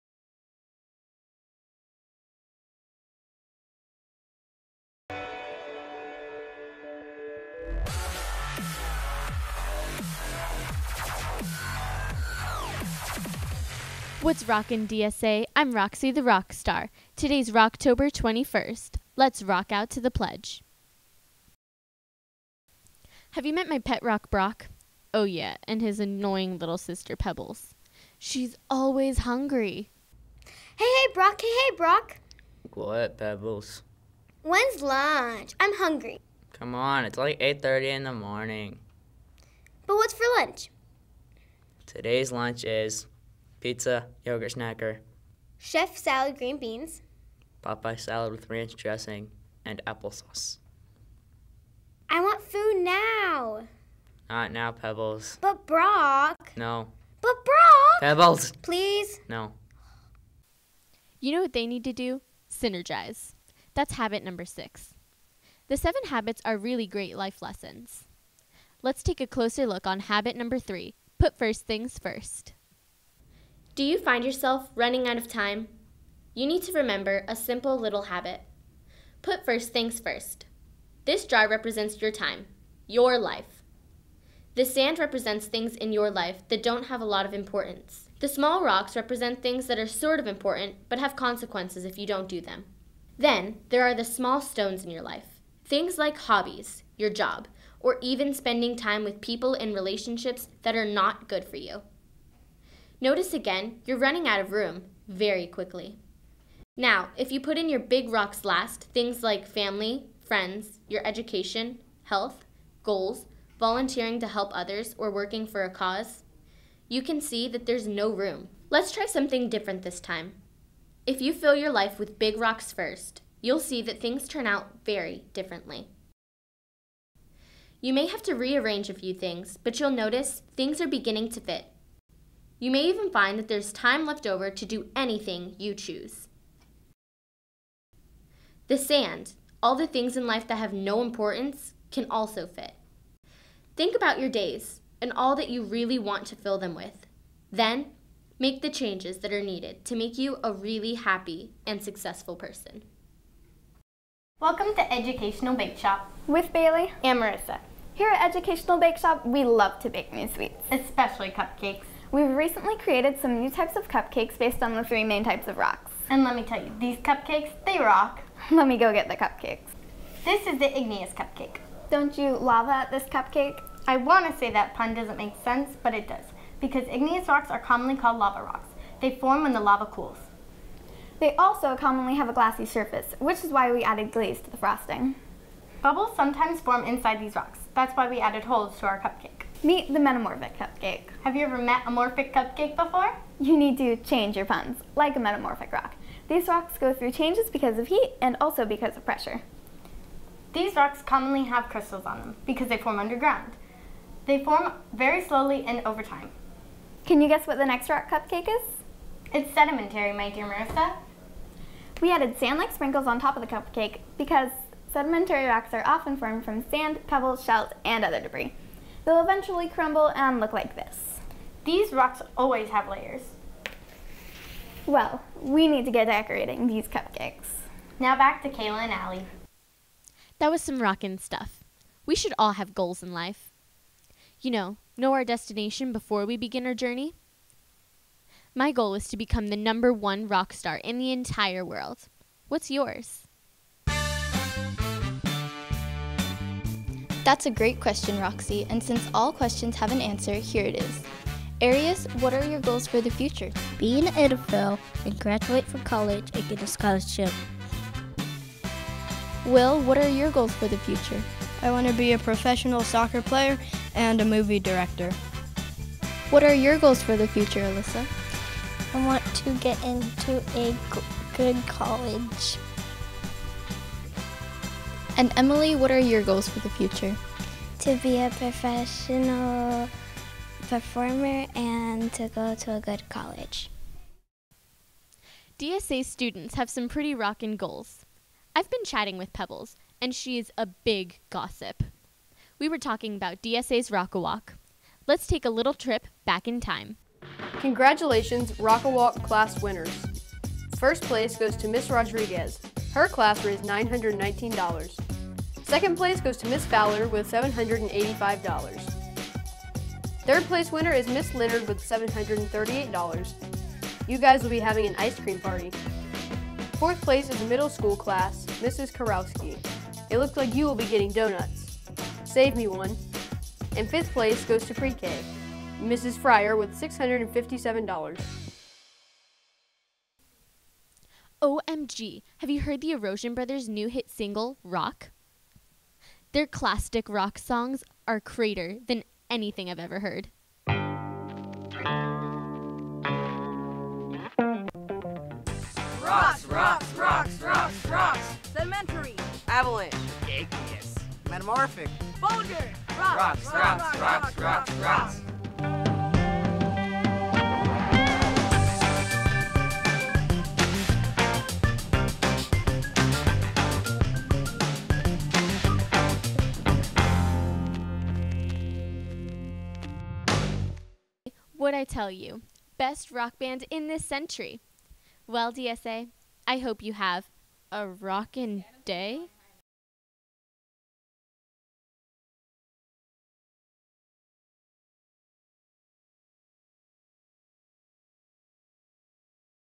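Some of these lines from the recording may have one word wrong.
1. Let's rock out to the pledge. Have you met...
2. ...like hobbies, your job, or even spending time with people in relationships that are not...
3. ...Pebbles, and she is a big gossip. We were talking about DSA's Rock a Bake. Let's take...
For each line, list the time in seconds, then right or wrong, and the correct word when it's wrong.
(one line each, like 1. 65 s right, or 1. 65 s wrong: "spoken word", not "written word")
1. 19 s right
2. 95 s right
3. 289 s wrong: "Walk", not "Bake".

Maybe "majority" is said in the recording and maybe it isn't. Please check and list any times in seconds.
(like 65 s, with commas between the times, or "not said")
not said.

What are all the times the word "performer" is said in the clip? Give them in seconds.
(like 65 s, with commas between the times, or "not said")
280 s.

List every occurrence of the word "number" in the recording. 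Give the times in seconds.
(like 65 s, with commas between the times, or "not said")
64 s, 70 s, 239 s.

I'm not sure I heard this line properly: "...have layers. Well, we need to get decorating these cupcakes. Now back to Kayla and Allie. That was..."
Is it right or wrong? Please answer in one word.
right.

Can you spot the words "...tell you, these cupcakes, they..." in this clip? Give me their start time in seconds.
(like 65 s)
166 s.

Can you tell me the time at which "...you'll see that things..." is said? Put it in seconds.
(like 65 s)
123 s.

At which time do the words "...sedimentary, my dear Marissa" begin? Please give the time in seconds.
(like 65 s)
209 s.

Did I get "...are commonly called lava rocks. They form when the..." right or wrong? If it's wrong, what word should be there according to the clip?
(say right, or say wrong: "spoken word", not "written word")
right.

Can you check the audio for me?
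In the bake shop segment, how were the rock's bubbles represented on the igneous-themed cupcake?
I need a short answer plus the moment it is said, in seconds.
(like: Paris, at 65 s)
Holes, at 188 s.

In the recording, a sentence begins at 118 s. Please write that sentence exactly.
Let's try something different this time.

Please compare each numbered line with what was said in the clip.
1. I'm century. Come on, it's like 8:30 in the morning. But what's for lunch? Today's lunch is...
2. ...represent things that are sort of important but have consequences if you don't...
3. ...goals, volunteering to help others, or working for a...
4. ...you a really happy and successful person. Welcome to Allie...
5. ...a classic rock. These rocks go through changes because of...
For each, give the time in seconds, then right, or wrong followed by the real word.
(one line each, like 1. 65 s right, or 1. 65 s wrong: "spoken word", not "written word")
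1. 35 s wrong: "hungry", not "century"
2. 88 s right
3. 112 s right
4. 150 s wrong: "Educational", not "Allie"
5. 195 s wrong: "metamorphic", not "classic".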